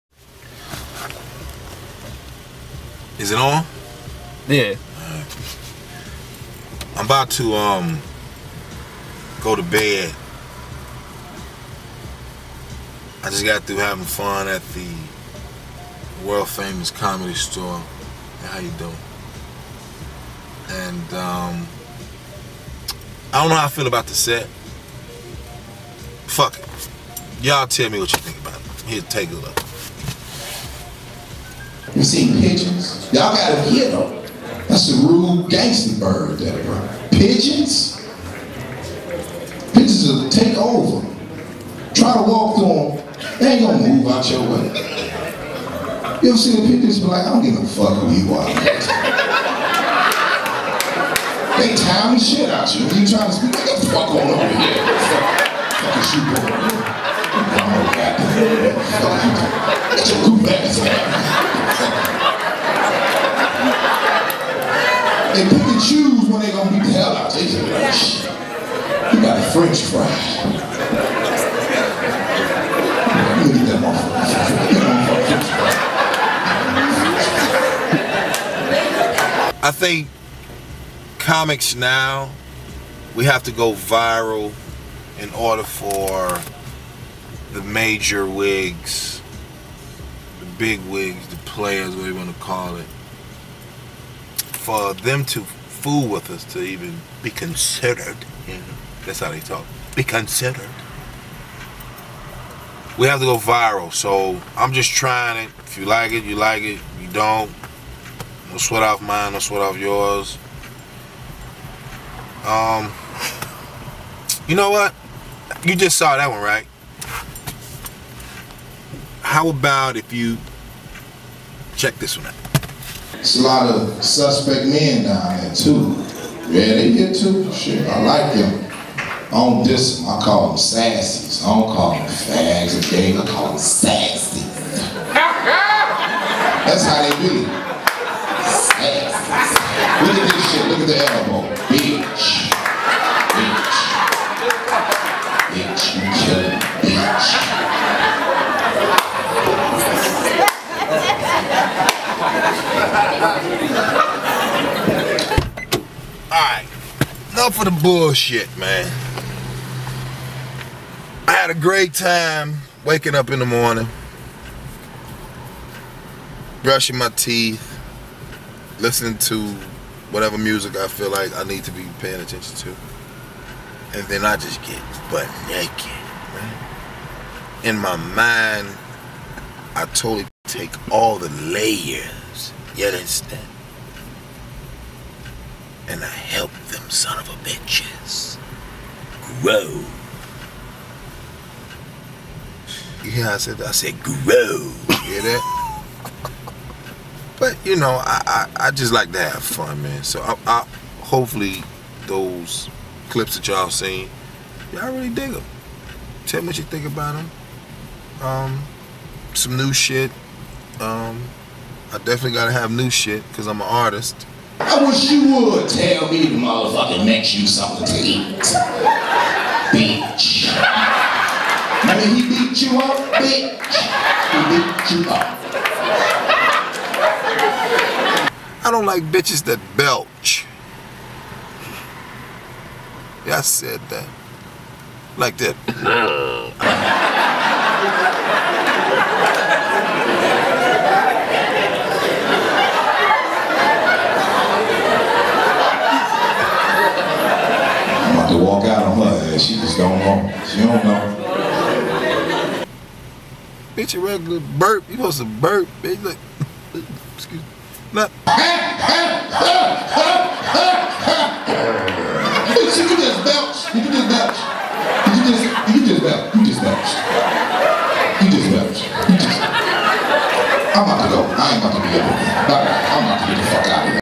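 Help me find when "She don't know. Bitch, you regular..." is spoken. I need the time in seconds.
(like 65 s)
250 s.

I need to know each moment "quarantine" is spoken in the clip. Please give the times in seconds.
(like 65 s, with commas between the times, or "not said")
not said.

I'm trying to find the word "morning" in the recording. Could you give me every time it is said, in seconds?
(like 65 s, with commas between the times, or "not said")
163 s.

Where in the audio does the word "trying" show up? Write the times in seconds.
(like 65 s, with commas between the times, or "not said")
53 s, 104 s.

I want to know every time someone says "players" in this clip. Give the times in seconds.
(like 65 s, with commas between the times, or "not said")
91 s.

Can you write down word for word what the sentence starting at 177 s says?
In my mind, I totally take all the layers, yet instead, And I help them son of a bitches grow.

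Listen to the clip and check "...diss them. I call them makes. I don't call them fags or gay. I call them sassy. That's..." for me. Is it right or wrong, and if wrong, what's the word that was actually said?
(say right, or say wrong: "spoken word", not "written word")
wrong: "sassies", not "makes".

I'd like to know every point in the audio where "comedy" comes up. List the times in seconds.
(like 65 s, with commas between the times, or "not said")
16 s.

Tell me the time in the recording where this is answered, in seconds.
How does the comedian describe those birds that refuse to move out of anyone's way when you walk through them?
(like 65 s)
35 s.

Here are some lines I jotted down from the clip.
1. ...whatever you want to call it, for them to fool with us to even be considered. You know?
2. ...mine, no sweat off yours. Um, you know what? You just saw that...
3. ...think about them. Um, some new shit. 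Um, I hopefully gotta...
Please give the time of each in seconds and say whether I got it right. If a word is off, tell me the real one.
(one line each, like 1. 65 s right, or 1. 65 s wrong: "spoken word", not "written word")
1. 91 s right
2. 109 s right
3. 206 s wrong: "definitely", not "hopefully".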